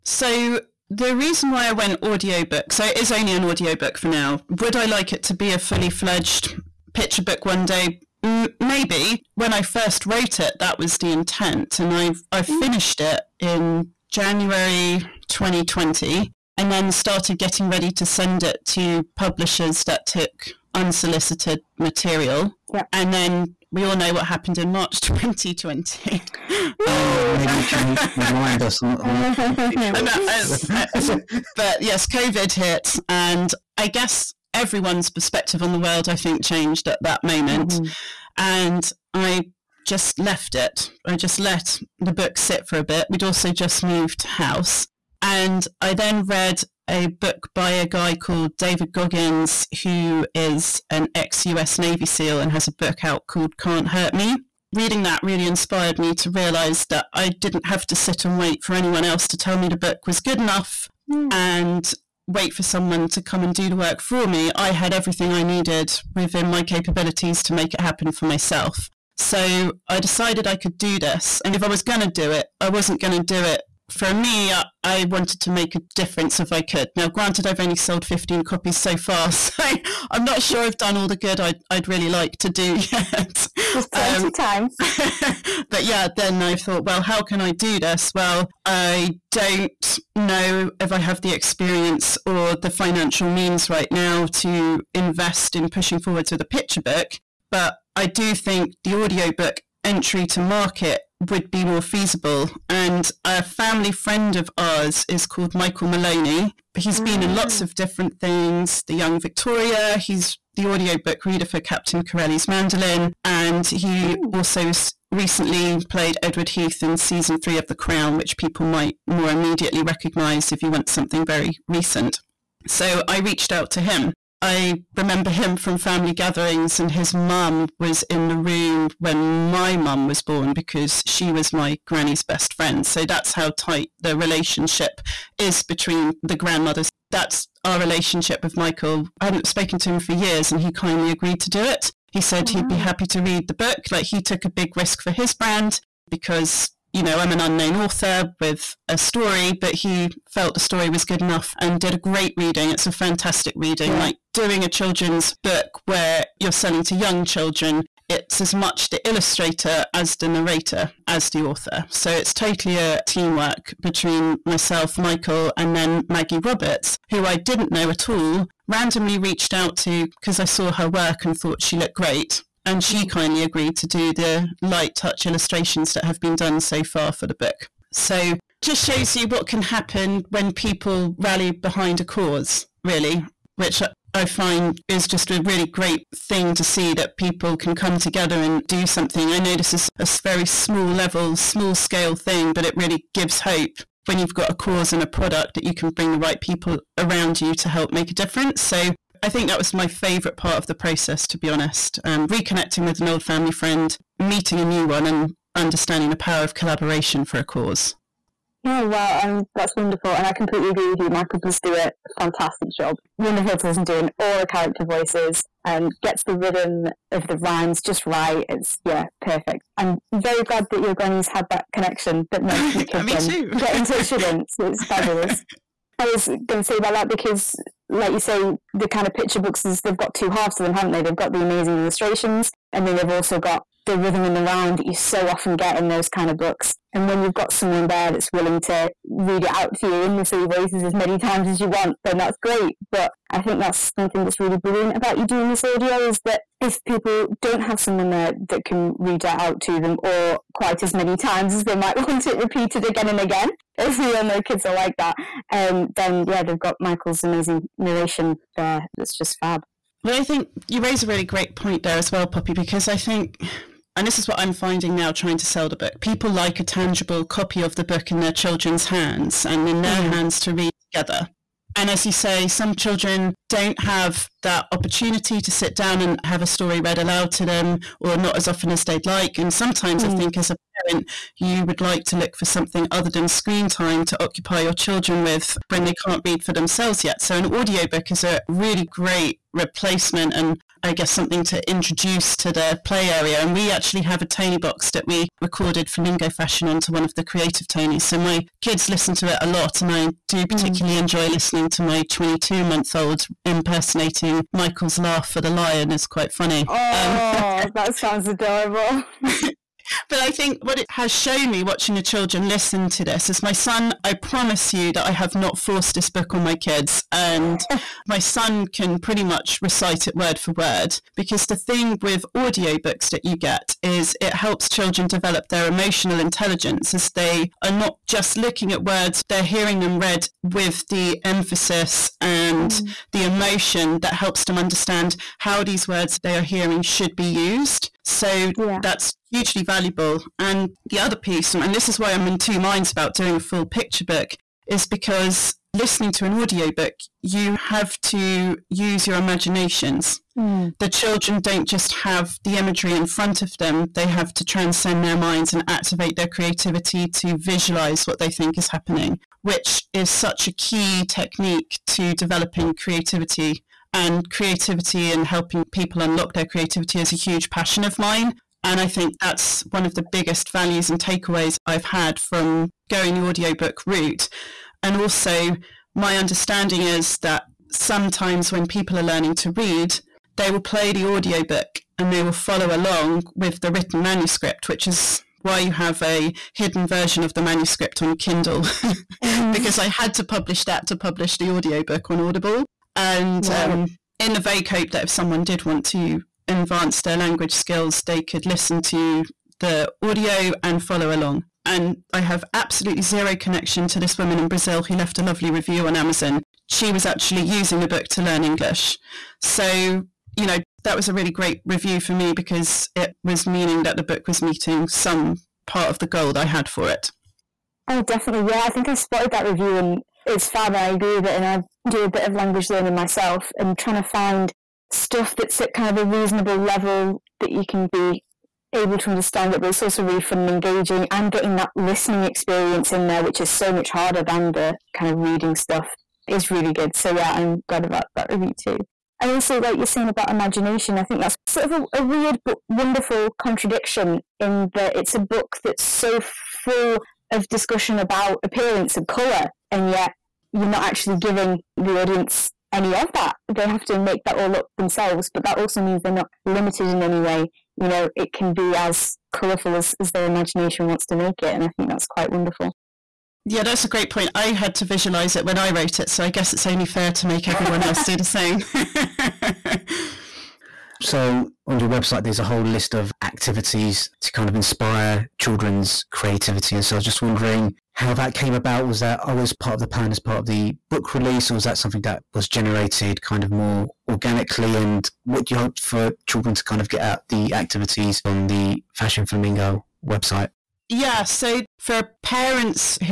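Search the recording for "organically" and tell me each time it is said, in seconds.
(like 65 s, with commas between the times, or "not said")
484 s.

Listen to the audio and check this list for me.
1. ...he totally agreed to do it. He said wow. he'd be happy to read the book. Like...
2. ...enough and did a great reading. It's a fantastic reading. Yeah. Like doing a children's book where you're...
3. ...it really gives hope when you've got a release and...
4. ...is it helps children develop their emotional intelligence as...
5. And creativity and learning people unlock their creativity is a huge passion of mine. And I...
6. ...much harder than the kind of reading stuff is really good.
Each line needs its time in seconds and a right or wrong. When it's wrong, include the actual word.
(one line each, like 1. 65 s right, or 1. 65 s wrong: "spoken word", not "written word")
1. 140 s wrong: "kindly", not "totally"
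2. 151 s right
3. 192 s wrong: "cause", not "release"
4. 323 s right
5. 363 s wrong: "helping", not "learning"
6. 433 s right.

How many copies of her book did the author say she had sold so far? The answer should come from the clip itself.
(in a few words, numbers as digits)
15.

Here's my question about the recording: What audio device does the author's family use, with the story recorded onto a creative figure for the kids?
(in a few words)
Toniebox.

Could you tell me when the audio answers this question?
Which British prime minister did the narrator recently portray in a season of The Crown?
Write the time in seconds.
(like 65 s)
116 s.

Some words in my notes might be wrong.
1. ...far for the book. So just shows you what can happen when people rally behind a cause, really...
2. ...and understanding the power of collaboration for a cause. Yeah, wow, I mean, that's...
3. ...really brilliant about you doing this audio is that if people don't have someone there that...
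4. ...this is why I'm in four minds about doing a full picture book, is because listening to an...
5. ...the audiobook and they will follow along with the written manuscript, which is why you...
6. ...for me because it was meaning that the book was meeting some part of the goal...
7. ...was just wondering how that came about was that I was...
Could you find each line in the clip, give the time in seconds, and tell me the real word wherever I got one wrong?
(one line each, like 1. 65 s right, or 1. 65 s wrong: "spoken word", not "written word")
1. 176 s right
2. 205 s right
3. 244 s right
4. 341 s wrong: "two", not "four"
5. 380 s right
6. 412 s right
7. 476 s right.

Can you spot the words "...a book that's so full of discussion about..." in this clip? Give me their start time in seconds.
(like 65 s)
445 s.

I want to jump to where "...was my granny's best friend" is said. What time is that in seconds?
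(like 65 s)
131 s.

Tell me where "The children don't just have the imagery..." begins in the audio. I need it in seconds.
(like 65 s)
350 s.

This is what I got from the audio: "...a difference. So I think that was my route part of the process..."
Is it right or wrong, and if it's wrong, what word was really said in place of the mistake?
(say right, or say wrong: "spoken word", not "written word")
wrong: "favorite", not "route".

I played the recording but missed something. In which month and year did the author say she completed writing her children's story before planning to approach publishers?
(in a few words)
January 2020.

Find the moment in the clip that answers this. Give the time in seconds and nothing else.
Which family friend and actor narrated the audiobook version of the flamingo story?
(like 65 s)
105 s.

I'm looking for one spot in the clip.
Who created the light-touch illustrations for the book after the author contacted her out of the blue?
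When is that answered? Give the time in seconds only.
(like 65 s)
166 s.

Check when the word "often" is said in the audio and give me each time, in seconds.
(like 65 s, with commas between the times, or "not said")
235 s, 278 s.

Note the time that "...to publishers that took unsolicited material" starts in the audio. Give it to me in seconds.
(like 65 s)
18 s.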